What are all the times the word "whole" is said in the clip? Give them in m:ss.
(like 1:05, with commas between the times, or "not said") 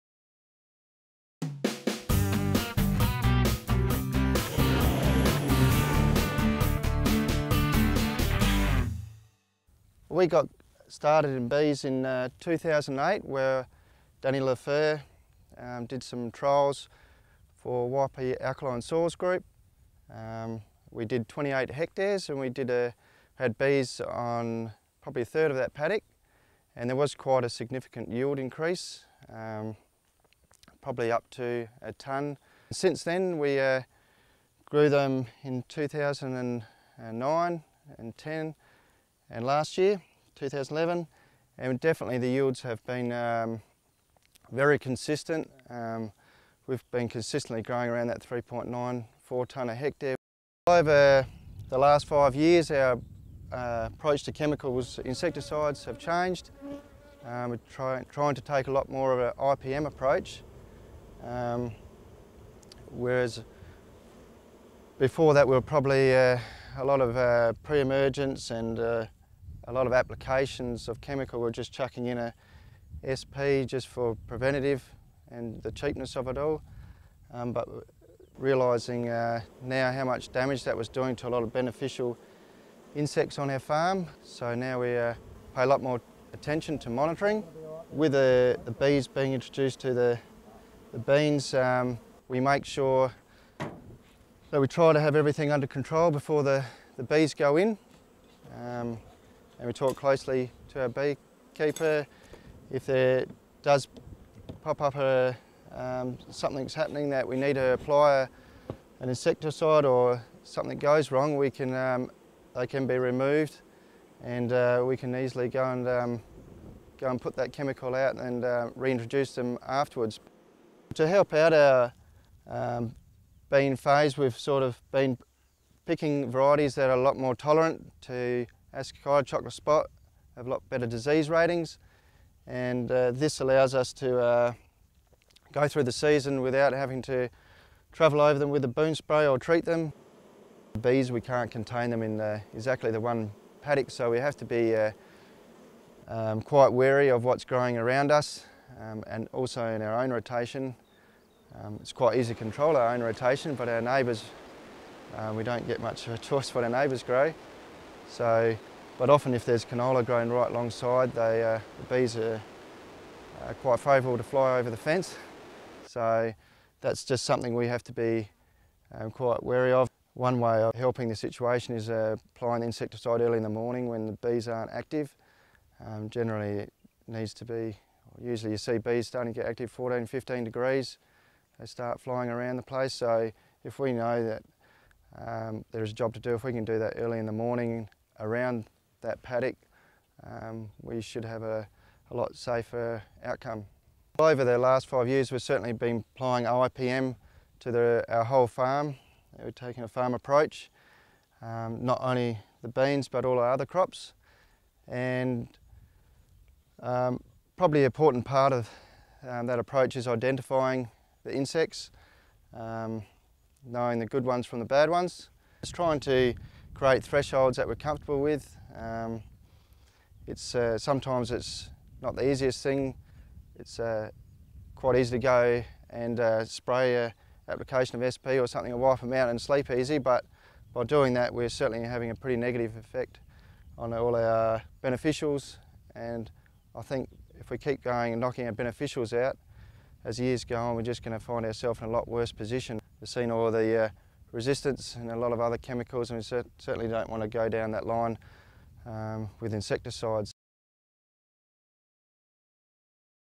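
3:18.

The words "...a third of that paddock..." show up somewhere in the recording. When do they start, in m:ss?
0:25.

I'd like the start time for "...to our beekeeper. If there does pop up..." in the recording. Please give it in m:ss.
1:40.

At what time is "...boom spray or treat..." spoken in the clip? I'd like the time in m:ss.
2:18.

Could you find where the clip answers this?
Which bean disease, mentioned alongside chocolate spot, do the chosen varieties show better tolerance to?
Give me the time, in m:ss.
2:08.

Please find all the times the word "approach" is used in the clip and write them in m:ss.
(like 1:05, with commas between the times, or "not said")
0:53, 0:59, 3:20, 3:29.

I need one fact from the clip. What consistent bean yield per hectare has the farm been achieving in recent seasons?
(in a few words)
3.94 tonnes.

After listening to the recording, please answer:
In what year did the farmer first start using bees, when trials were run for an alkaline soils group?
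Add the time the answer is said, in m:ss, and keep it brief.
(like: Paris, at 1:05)
2008, at 0:12.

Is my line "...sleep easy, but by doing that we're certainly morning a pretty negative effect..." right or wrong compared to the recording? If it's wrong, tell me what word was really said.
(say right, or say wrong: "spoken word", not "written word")
wrong: "having", not "morning".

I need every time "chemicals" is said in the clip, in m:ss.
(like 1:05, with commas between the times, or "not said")
0:54, 1:11, 1:57, 4:05.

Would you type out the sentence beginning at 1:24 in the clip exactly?
So now we uh, pay a lot more attention to monitoring.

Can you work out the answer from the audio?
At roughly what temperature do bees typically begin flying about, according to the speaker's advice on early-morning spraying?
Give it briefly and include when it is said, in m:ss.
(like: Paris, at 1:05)
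14 to 15 degrees, at 2:59.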